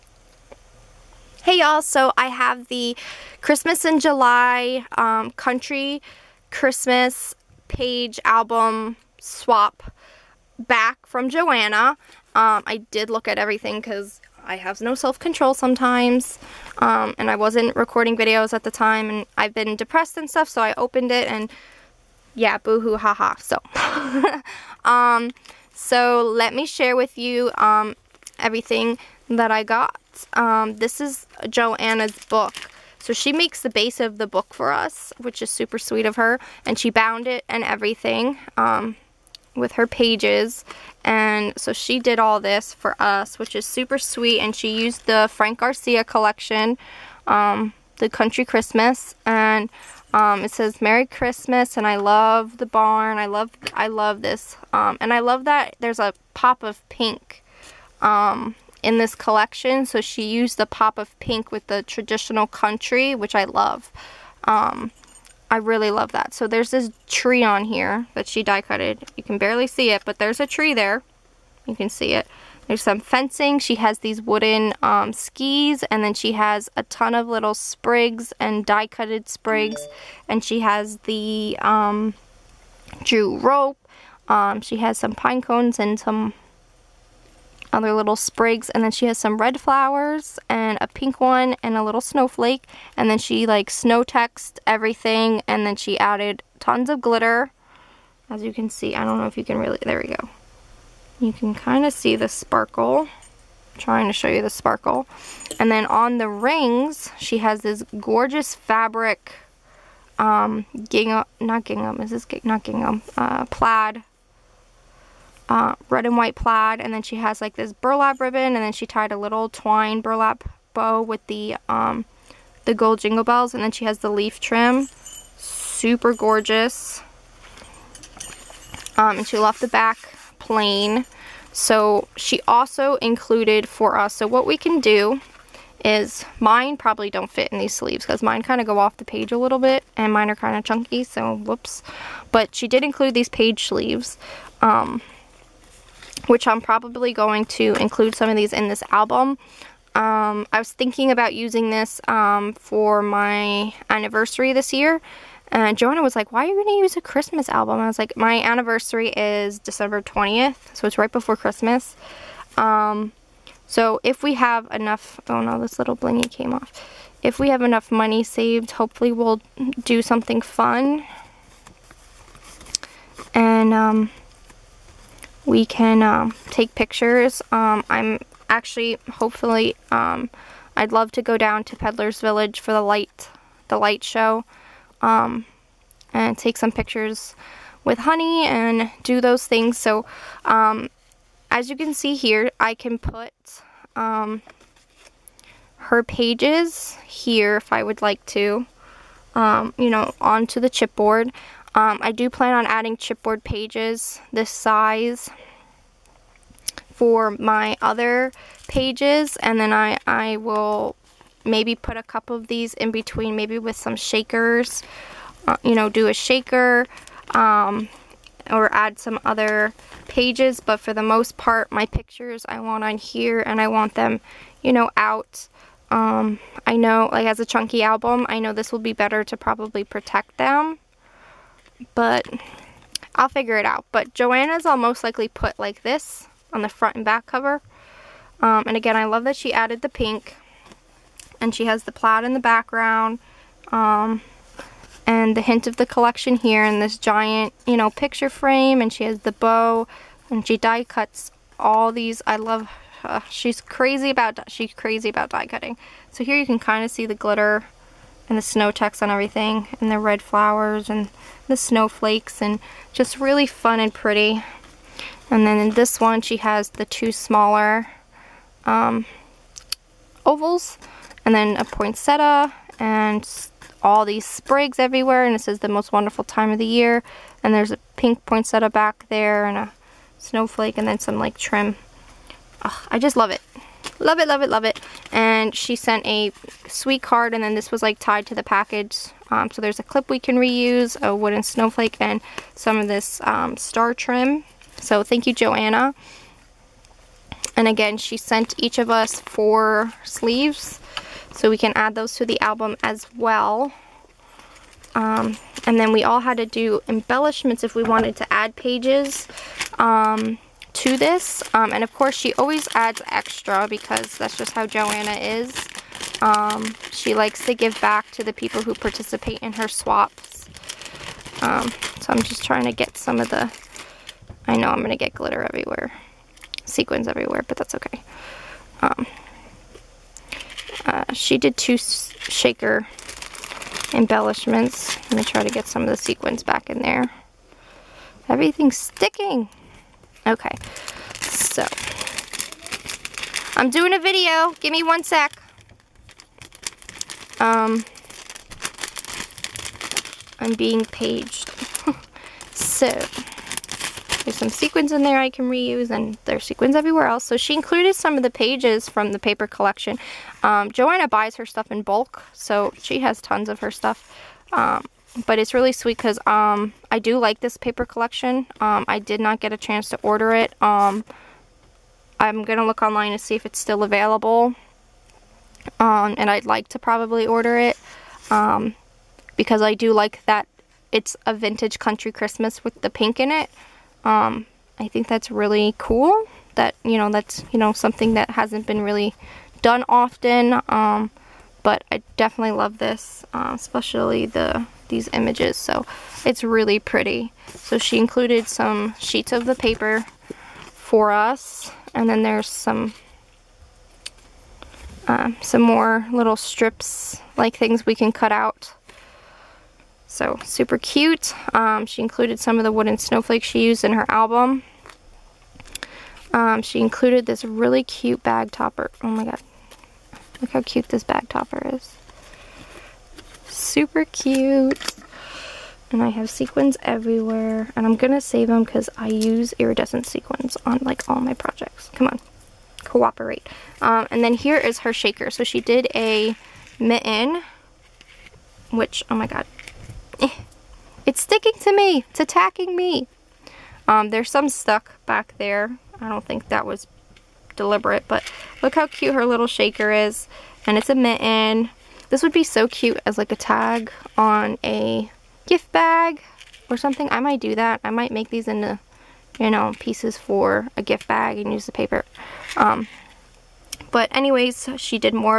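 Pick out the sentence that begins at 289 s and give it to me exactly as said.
Um, so there's a clip we can reuse, a wooden snowflake, and some of this um, star trim.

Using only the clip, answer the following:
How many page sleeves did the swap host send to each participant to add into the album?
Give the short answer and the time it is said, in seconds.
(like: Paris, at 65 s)
4, at 299 s.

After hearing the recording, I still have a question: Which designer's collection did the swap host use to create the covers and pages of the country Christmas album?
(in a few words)
Frank Garcia.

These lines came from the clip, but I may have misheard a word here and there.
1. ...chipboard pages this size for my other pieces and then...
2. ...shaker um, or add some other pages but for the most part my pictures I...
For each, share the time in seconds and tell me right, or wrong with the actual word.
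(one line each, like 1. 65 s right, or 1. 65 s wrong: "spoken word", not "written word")
1. 202 s wrong: "pages", not "pieces"
2. 216 s right.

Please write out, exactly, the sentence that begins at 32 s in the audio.
So she makes the base of the book for us, which is super sweet of her.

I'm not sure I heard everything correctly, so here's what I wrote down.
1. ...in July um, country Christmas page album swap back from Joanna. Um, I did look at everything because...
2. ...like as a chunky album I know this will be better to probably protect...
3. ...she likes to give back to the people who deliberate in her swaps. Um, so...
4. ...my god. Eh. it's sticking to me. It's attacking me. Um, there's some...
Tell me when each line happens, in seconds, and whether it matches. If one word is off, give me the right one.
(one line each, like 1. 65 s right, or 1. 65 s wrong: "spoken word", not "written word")
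1. 3 s right
2. 227 s right
3. 316 s wrong: "participate", not "deliberate"
4. 439 s right.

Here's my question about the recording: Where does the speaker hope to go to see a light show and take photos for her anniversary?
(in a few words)
Peddler's Village.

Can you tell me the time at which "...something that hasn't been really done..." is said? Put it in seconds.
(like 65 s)
387 s.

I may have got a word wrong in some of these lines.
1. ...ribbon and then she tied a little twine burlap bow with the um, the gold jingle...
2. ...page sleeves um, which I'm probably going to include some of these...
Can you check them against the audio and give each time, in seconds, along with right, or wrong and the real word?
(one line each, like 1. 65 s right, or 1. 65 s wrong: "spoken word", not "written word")
1. 118 s right
2. 143 s right.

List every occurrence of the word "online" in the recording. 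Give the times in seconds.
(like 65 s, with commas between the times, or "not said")
372 s.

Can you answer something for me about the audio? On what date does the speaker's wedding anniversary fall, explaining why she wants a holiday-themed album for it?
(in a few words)
December 20th.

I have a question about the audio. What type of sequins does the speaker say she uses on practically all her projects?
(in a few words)
iridescent.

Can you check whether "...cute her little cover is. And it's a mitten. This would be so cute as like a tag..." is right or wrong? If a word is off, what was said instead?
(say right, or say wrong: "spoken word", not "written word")
wrong: "shaker", not "cover".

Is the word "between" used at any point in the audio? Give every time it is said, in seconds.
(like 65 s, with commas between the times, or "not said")
212 s.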